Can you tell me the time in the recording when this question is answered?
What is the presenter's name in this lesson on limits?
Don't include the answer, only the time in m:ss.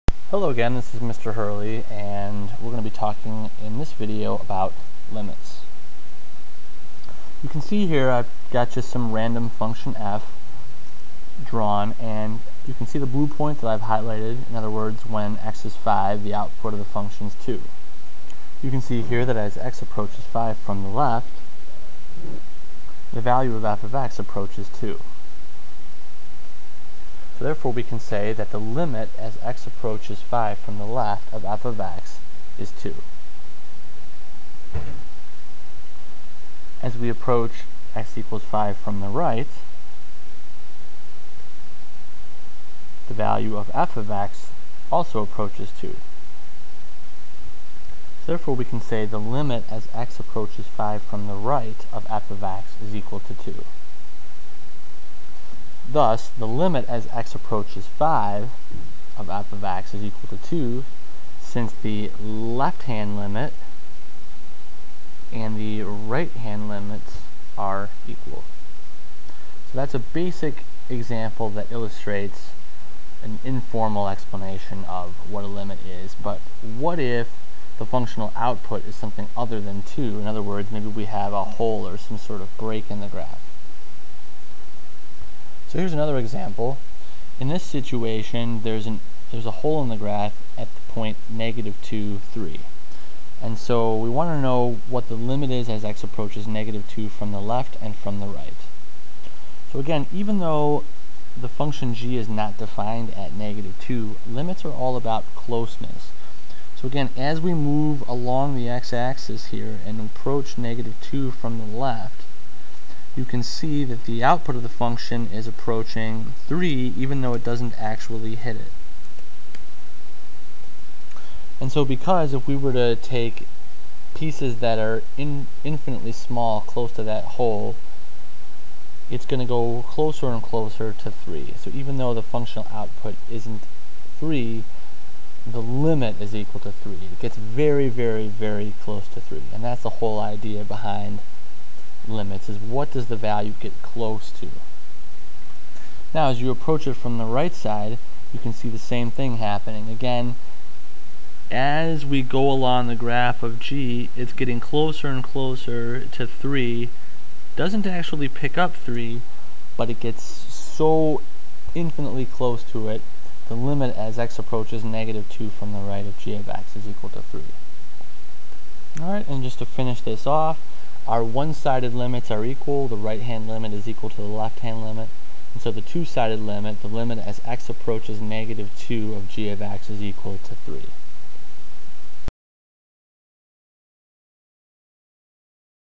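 0:01.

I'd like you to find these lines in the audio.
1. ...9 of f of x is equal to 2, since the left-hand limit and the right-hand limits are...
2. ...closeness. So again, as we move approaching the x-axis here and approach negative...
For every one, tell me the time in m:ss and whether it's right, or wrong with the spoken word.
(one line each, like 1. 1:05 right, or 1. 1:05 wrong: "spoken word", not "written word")
1. 0:57 wrong: "5", not "9"
2. 1:45 wrong: "along", not "approaching".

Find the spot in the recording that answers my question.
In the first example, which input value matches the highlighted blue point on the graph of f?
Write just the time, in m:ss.
0:15.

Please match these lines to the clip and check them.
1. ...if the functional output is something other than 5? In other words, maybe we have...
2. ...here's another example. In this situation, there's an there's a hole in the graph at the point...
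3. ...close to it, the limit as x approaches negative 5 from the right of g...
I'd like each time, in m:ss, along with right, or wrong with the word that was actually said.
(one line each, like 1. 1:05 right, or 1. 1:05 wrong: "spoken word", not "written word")
1. 1:16 wrong: "2", not "5"
2. 1:25 right
3. 2:42 wrong: "2", not "5".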